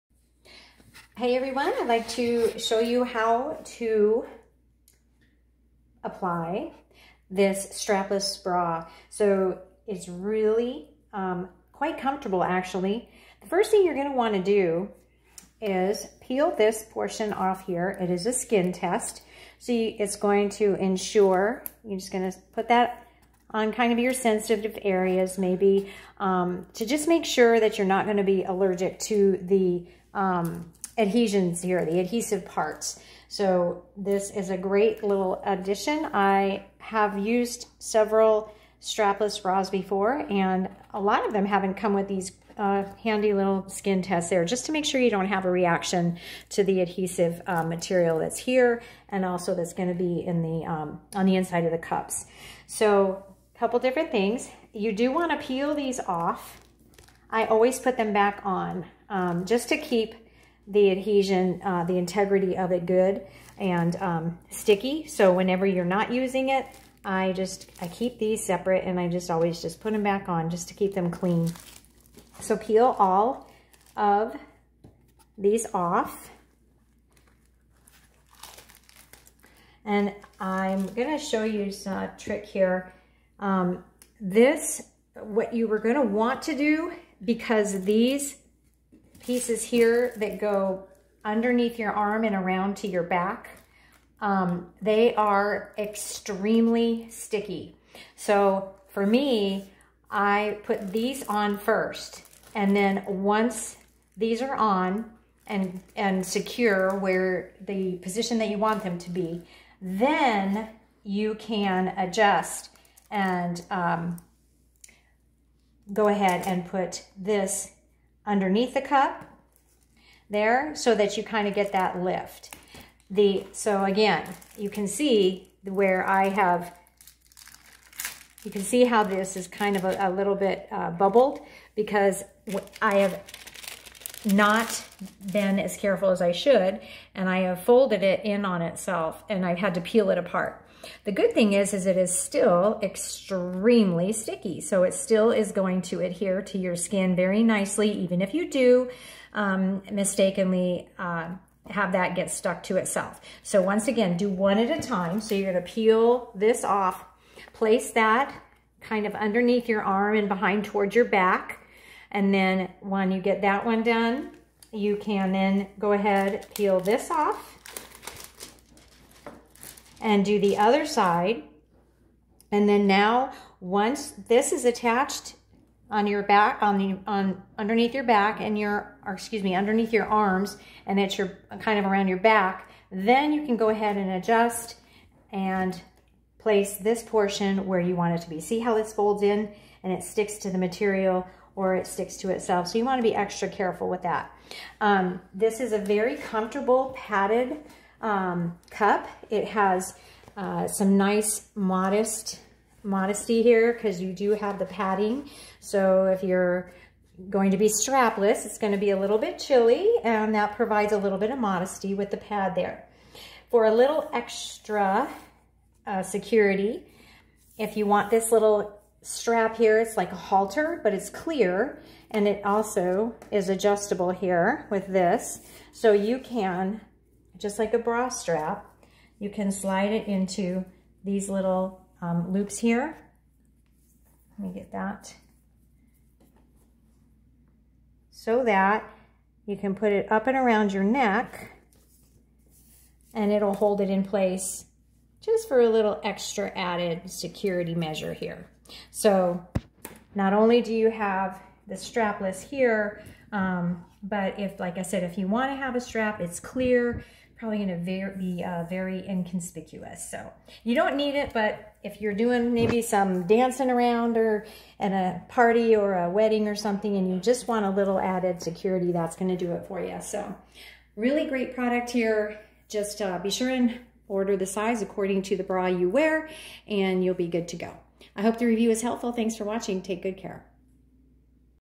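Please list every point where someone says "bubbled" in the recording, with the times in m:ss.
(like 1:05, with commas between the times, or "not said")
2:10.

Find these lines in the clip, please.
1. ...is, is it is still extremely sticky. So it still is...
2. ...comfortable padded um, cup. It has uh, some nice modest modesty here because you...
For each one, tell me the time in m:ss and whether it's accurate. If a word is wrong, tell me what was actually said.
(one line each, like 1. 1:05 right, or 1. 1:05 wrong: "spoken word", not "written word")
1. 2:21 right
2. 3:16 right.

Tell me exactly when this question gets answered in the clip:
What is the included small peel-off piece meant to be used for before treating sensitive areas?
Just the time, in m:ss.
0:18.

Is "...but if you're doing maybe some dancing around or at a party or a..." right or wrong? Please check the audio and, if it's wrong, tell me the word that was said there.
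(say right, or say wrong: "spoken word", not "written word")
right.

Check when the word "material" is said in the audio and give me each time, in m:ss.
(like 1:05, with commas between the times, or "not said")
0:47, 3:10.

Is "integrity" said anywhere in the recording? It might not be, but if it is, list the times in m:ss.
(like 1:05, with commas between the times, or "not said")
1:01.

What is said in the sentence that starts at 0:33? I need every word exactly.
So this is a great little addition.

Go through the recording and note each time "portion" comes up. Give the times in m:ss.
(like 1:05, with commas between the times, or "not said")
0:16, 3:07.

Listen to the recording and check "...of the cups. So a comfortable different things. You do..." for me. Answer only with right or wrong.
wrong.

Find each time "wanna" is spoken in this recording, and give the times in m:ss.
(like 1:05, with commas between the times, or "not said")
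0:14, 0:55, 4:15.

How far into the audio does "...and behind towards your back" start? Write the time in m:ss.
2:40.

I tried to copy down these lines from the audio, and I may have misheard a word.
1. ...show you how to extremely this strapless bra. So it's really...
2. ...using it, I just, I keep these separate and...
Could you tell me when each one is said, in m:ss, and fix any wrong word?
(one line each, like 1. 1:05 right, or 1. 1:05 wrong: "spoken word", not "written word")
1. 0:02 wrong: "apply", not "extremely"
2. 1:06 right.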